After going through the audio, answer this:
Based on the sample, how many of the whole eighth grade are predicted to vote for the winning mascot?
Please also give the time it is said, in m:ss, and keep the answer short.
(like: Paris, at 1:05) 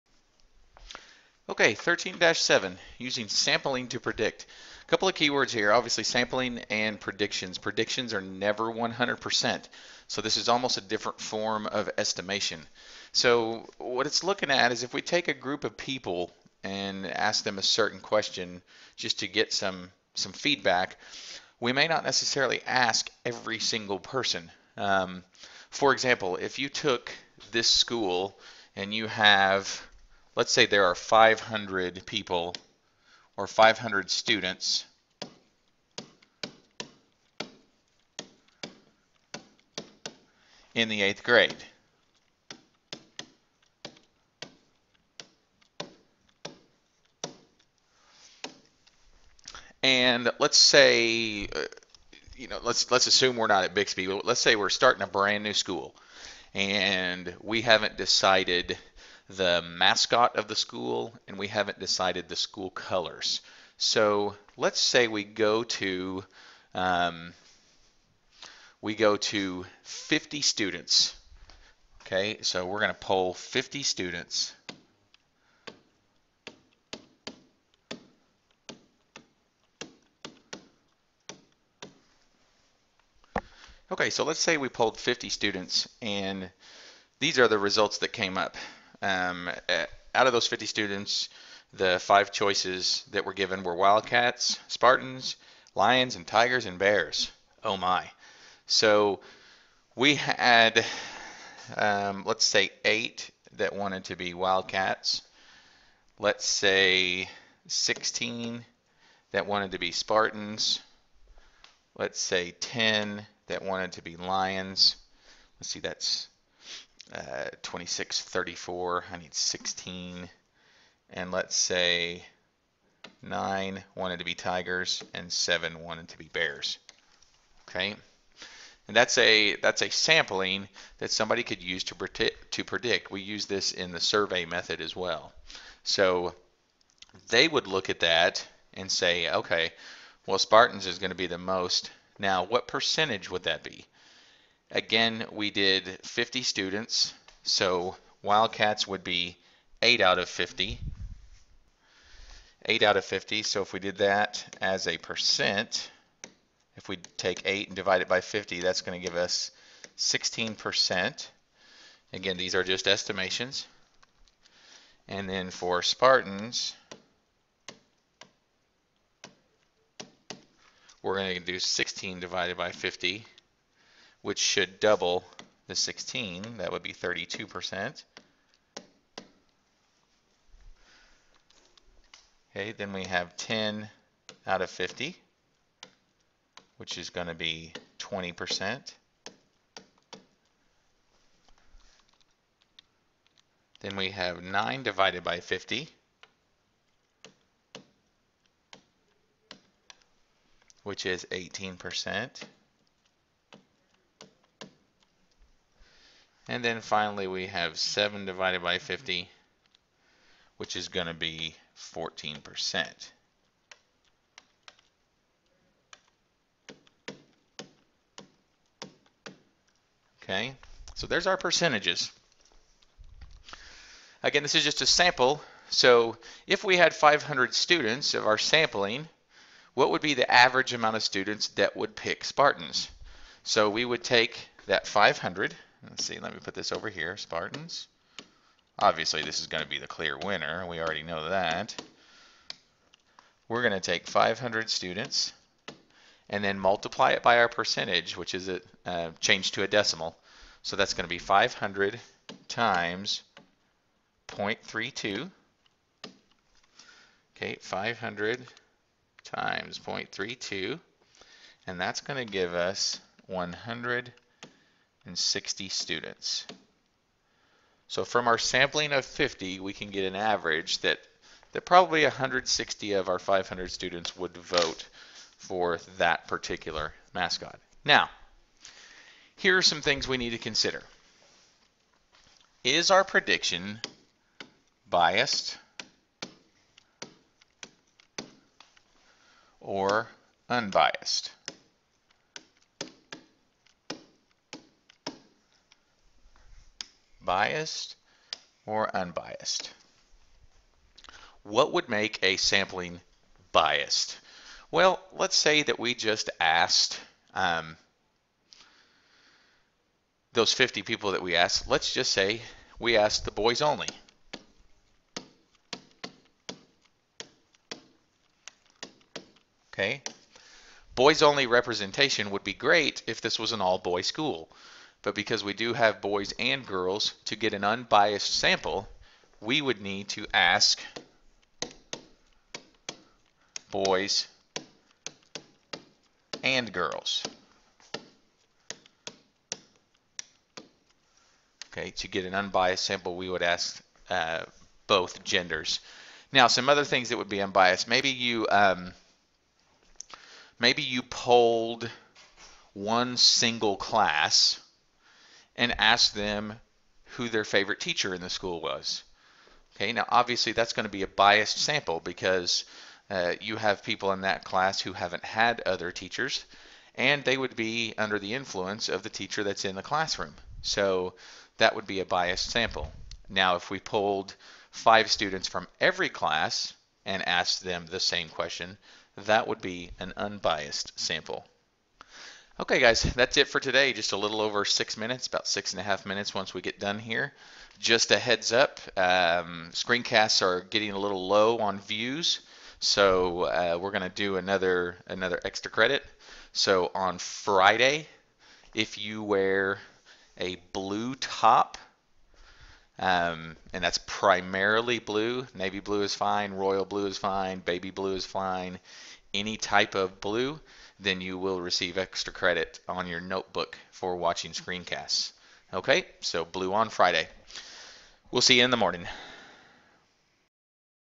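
160, at 4:23.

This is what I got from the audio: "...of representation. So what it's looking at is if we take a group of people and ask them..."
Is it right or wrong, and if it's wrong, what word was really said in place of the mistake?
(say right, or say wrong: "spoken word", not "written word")
wrong: "estimation", not "representation".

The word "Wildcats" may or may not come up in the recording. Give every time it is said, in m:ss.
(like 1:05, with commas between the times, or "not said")
1:33, 1:44, 2:28.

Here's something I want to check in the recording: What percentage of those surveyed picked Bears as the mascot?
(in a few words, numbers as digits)
14%.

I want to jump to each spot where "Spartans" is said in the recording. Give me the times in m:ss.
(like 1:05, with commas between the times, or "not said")
1:34, 1:49, 2:20, 2:45, 3:52, 3:57.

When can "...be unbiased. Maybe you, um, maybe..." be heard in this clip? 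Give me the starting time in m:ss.
5:47.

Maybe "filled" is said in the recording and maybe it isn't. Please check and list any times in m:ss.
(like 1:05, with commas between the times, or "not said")
not said.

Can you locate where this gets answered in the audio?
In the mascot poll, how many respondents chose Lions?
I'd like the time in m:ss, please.
1:52.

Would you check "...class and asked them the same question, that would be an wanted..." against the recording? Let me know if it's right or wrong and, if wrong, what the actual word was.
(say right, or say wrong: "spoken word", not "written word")
wrong: "unbiased", not "wanted".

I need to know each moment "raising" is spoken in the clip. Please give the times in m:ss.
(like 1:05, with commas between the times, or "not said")
not said.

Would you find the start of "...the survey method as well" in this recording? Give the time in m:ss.
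2:13.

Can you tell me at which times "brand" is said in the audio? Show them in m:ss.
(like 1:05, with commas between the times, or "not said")
0:55.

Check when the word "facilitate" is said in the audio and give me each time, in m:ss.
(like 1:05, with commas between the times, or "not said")
not said.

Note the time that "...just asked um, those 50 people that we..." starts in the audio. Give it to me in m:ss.
5:05.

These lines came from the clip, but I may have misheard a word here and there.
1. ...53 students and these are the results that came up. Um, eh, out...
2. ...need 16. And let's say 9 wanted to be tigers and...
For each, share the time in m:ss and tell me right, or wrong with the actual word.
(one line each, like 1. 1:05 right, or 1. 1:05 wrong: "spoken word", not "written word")
1. 1:24 wrong: "50", not "53"
2. 1:59 right.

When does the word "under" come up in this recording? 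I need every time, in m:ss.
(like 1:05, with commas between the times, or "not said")
6:07.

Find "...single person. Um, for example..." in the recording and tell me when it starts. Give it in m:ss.
0:23.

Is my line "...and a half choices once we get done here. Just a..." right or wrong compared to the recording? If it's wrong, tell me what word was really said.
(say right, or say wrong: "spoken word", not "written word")
wrong: "minutes", not "choices".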